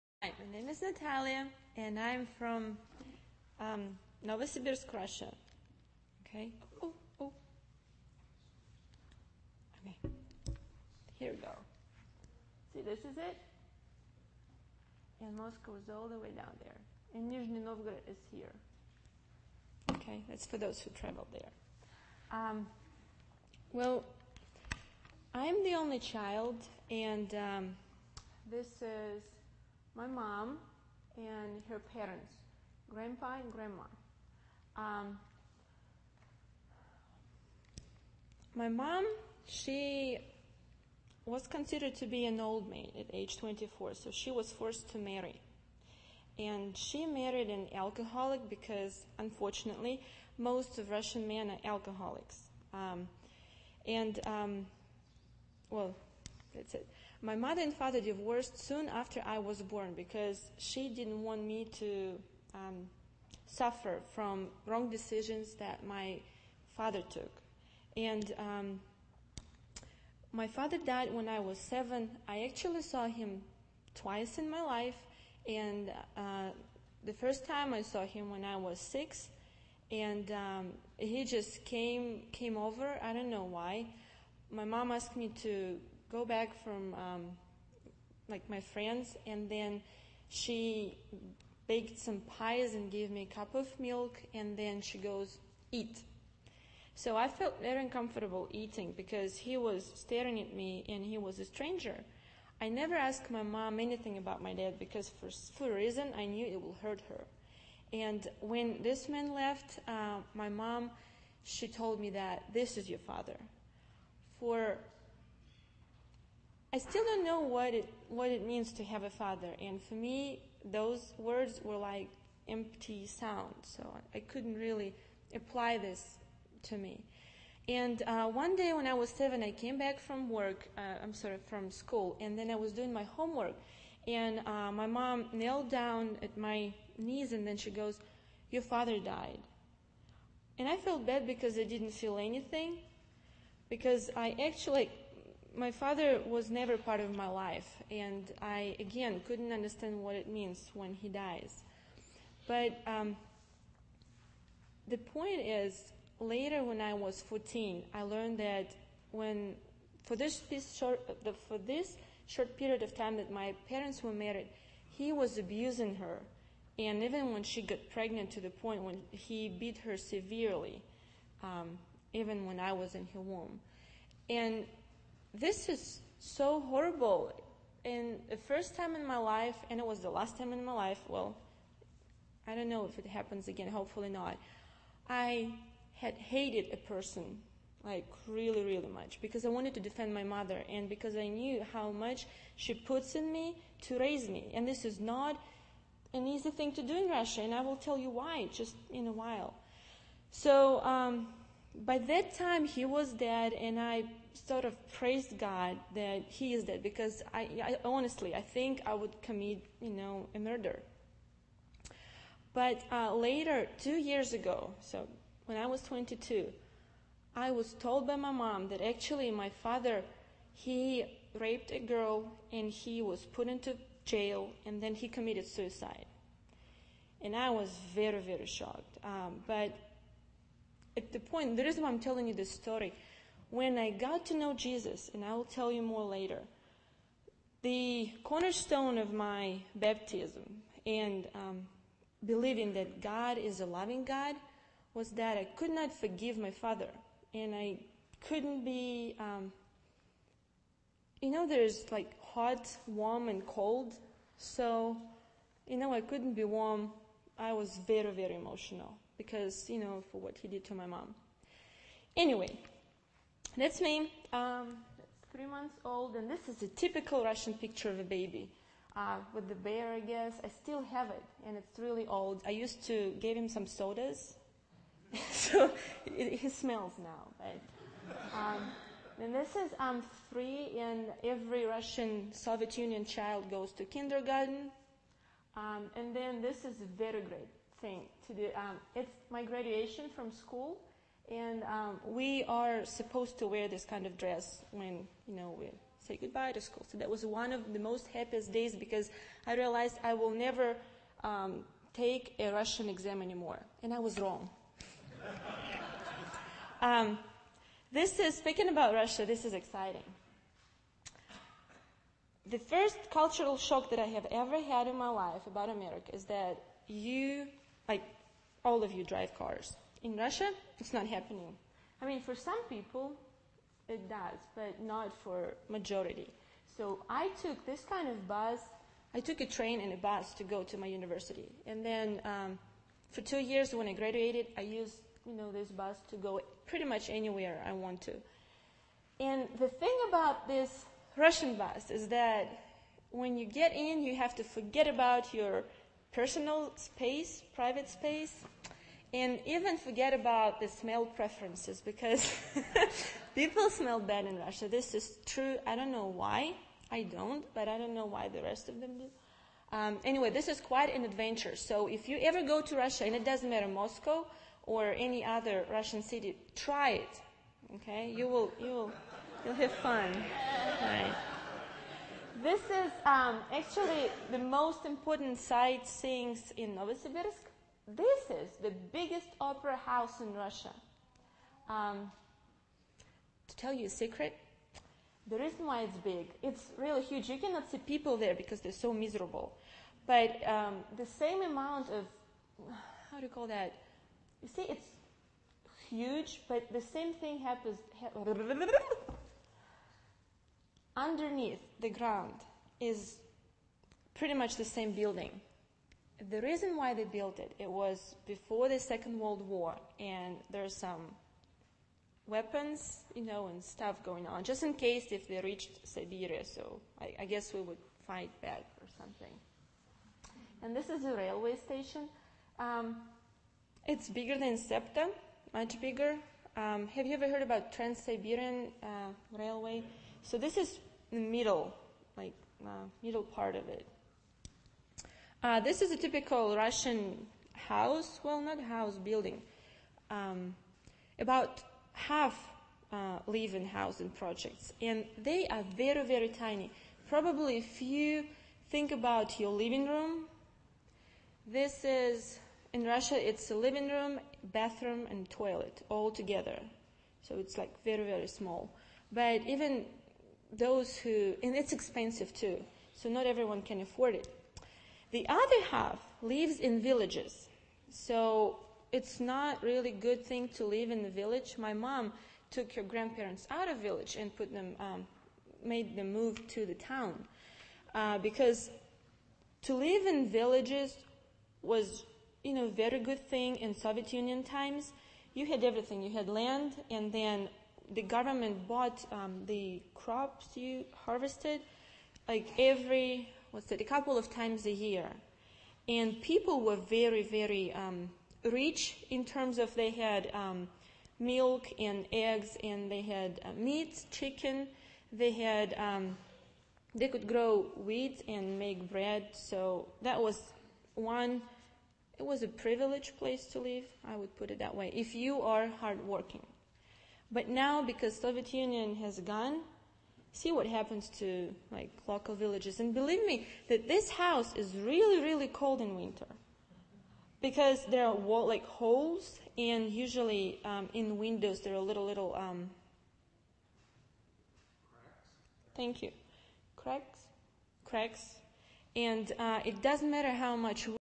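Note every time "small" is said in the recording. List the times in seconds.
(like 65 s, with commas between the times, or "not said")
458 s.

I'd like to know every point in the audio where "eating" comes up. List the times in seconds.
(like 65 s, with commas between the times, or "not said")
98 s.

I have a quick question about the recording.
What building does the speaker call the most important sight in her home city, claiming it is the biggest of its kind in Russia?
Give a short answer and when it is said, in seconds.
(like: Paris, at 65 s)
Opera house, at 379 s.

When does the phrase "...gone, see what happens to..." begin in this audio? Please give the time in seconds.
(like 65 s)
519 s.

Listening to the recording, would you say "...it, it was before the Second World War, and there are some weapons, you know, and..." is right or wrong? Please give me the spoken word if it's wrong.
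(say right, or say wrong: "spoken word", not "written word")
right.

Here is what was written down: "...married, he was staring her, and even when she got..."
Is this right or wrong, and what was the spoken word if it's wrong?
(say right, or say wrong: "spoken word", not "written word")
wrong: "abusing", not "staring".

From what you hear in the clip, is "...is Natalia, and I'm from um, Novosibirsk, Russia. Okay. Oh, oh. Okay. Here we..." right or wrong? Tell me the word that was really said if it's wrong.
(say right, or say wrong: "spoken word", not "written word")
right.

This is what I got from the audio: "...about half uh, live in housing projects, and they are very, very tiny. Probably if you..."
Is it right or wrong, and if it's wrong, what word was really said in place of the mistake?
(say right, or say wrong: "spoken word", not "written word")
right.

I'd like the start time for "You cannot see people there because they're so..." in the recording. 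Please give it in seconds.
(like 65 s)
387 s.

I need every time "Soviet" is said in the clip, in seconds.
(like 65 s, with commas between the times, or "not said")
282 s, 483 s, 518 s.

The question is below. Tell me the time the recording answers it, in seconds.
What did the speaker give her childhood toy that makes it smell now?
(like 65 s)
273 s.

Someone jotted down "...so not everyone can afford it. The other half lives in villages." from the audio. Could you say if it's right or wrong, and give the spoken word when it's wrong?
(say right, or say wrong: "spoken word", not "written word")
right.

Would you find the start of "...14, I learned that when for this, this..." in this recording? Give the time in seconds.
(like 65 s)
157 s.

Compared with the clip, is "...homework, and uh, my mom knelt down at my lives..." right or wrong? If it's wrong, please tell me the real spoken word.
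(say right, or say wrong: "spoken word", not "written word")
wrong: "knees", not "lives".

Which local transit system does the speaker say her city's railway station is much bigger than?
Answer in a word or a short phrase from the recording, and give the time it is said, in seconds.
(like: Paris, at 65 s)
SEPTA, at 424 s.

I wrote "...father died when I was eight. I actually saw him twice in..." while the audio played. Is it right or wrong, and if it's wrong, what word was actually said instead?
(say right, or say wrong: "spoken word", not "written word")
wrong: "seven", not "eight".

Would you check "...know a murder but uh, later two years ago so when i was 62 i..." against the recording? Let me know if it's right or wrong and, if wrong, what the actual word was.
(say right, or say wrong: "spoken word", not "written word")
wrong: "22", not "62".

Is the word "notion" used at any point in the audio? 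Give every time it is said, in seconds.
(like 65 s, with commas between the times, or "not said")
not said.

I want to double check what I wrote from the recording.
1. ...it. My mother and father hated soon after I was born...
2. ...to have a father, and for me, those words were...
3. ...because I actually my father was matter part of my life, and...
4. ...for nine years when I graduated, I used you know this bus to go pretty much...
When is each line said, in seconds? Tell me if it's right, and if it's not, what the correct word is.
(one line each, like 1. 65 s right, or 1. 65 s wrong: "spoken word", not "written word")
1. 56 s wrong: "divorced", not "hated"
2. 118 s right
3. 143 s wrong: "never", not "matter"
4. 333 s wrong: "two", not "nine".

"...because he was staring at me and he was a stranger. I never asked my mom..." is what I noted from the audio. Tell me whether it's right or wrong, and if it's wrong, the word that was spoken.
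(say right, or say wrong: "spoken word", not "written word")
right.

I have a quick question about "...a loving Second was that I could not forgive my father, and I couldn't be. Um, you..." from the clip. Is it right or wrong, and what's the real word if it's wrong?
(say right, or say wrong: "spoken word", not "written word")
wrong: "God", not "Second".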